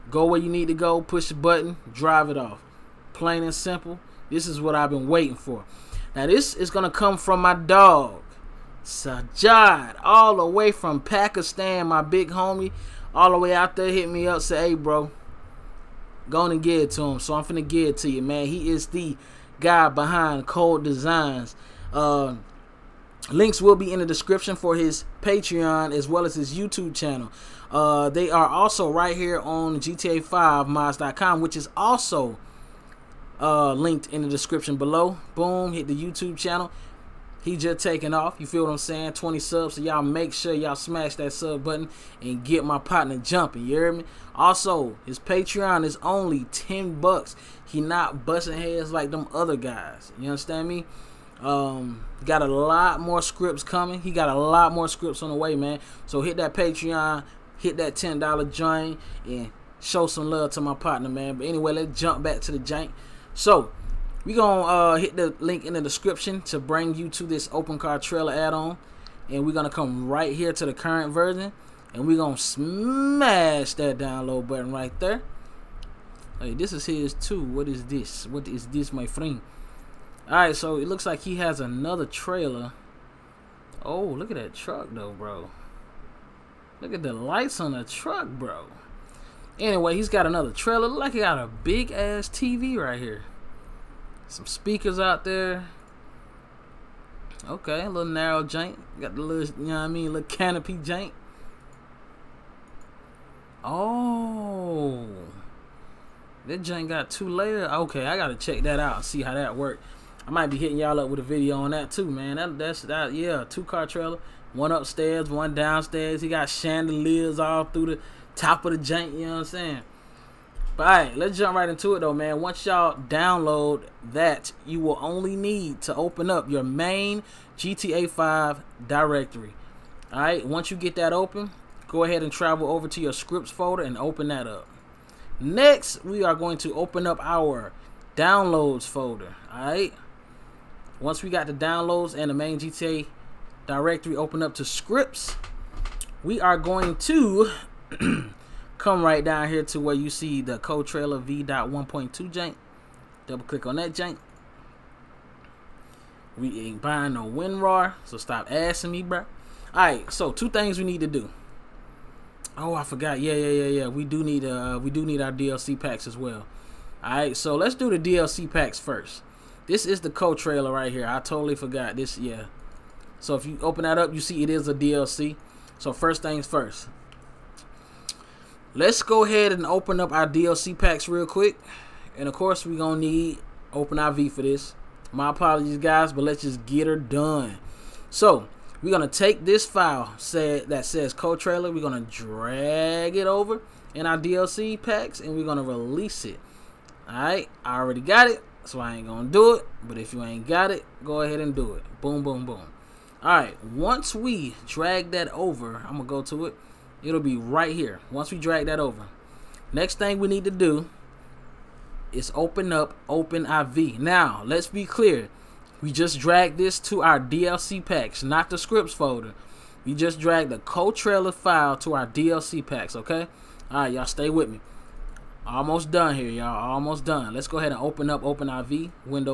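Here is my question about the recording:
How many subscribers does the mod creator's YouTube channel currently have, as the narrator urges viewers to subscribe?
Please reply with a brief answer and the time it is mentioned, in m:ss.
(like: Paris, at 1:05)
20, at 0:39.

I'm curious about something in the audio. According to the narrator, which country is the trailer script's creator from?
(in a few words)
Pakistan.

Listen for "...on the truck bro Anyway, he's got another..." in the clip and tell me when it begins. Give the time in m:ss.
1:27.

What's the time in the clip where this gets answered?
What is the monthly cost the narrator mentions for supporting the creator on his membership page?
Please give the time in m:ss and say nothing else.
0:46.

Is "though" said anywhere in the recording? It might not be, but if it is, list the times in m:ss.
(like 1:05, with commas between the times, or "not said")
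1:24, 2:01.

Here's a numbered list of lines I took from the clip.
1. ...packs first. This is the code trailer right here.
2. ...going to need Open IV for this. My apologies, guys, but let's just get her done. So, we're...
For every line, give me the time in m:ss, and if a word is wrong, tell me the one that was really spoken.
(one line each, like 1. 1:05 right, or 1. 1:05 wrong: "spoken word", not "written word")
1. 2:48 right
2. 3:02 right.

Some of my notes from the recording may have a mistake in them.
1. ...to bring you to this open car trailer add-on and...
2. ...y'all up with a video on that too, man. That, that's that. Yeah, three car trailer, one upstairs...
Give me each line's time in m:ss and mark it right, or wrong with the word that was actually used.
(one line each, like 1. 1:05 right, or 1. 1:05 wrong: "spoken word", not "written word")
1. 1:06 right
2. 1:50 wrong: "two", not "three".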